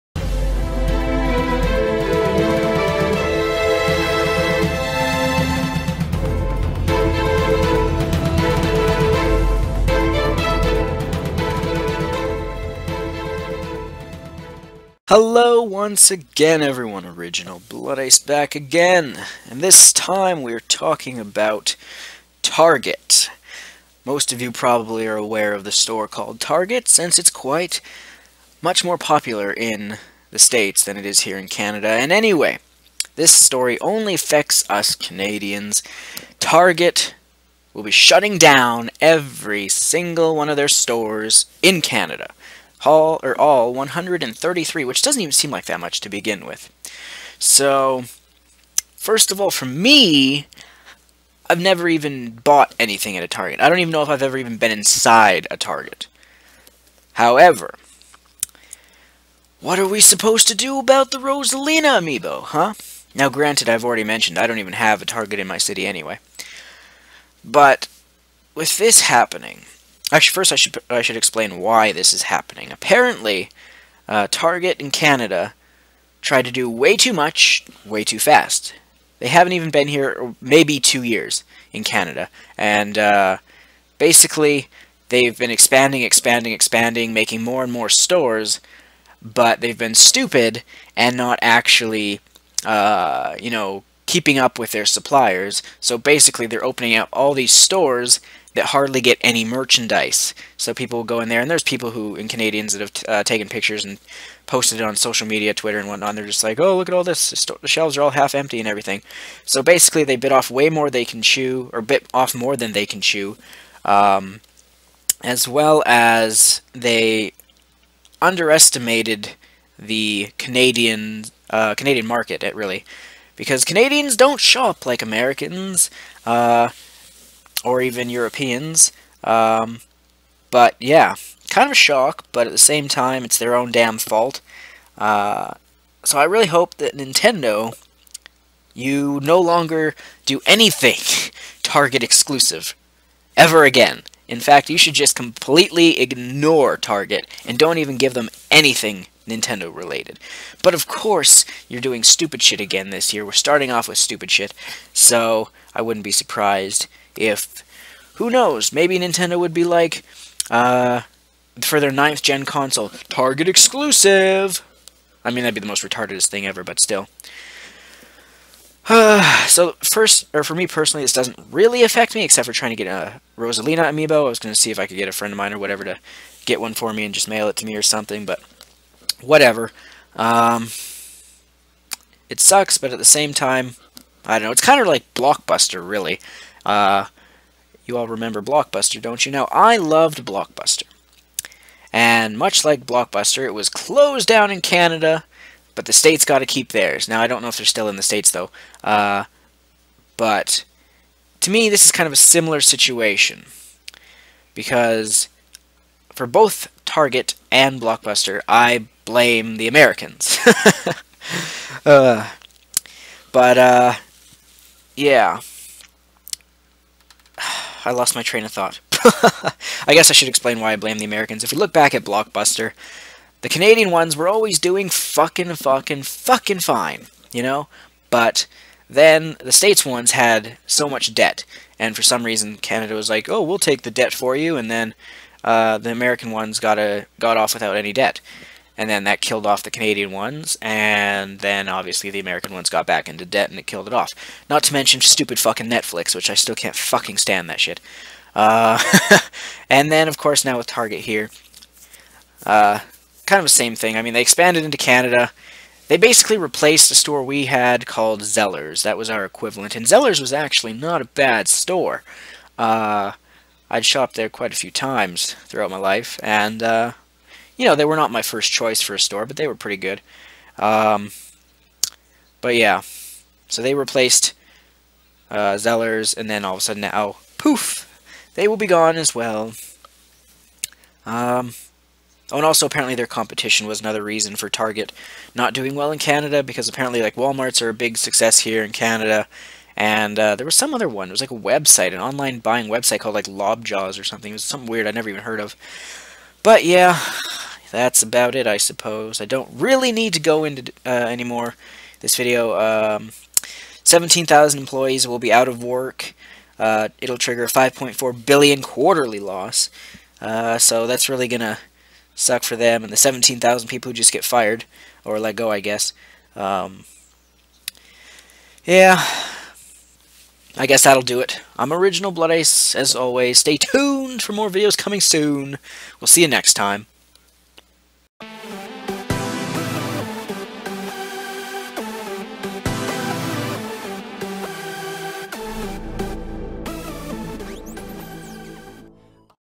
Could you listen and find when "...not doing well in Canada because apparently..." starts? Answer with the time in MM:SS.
04:45.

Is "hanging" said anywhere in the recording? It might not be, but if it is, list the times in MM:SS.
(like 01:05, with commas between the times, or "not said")
not said.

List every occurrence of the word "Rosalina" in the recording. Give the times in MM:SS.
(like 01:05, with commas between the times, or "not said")
01:01, 02:53.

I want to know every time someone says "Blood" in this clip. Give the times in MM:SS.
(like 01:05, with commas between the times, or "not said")
00:17, 05:22.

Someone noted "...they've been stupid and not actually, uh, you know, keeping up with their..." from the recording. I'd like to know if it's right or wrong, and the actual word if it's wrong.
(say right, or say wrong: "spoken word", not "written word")
right.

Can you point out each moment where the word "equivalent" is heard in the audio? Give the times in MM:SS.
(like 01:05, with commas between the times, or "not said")
04:19.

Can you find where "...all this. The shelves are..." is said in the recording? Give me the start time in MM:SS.
01:46.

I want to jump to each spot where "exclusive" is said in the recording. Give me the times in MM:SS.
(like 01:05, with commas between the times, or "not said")
02:22, 02:43.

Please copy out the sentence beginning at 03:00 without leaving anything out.
Um, it sucks, but at the same time, I don't know.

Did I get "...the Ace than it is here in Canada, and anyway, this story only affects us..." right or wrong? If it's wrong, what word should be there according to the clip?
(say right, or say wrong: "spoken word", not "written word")
wrong: "States", not "Ace".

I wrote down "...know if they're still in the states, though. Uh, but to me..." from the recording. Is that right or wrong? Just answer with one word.
right.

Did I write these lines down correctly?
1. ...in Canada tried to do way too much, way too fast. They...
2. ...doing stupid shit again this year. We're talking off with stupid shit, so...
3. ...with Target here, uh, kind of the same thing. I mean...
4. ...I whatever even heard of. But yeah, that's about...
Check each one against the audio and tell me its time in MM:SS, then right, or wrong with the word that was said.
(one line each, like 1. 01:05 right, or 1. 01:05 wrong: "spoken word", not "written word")
1. 01:14 right
2. 02:31 wrong: "starting", not "talking"
3. 04:10 right
4. 04:54 wrong: "never", not "whatever".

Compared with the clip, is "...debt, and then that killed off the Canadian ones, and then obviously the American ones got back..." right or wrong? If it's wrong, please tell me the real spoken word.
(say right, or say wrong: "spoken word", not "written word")
right.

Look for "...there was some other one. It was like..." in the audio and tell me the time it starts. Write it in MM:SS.
04:50.